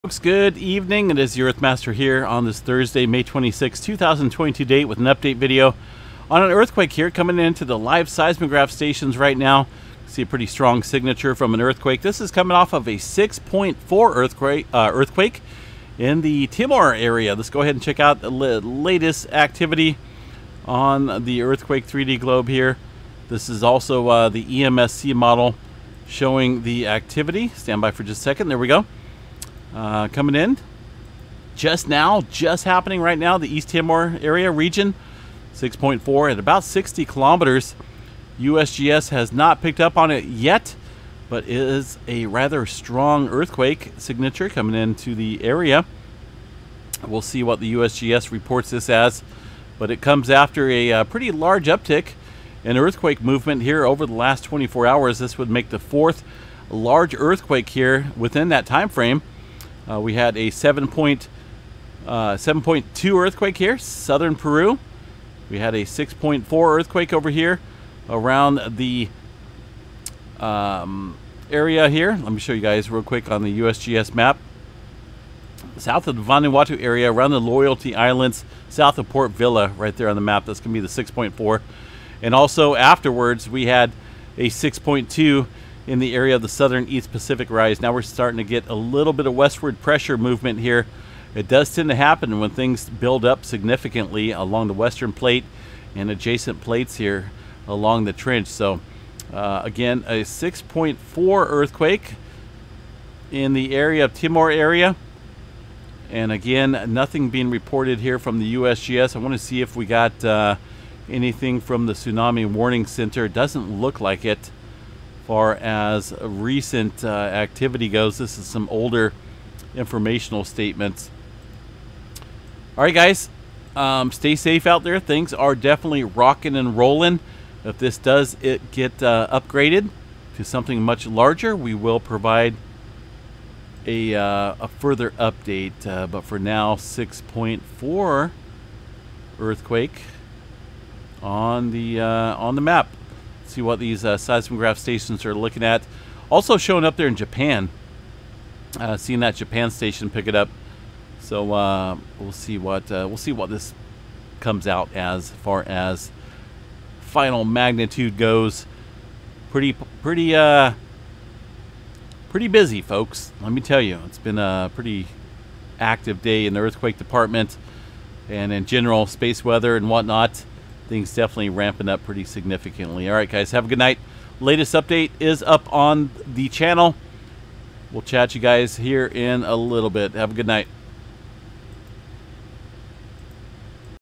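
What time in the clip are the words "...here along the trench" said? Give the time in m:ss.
1:36.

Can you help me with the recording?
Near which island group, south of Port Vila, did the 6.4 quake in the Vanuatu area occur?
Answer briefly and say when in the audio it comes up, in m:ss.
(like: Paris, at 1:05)
Loyalty Islands, at 1:17.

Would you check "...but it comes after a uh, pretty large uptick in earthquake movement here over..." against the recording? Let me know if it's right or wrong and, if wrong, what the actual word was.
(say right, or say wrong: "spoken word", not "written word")
right.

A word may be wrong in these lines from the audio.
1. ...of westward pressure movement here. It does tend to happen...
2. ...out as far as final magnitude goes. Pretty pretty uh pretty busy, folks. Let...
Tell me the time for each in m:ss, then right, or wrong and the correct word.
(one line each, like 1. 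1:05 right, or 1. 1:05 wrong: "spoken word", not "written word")
1. 1:29 right
2. 2:34 right.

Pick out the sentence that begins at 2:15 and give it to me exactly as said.
Uh, but for now, 6.4 earthquake on the uh, on the map see what these uh, seismograph stations are looking at.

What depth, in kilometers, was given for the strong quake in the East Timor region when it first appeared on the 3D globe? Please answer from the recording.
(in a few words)
60 kilometers.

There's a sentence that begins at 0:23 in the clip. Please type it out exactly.
This is also uh, the EMSC model showing the activity.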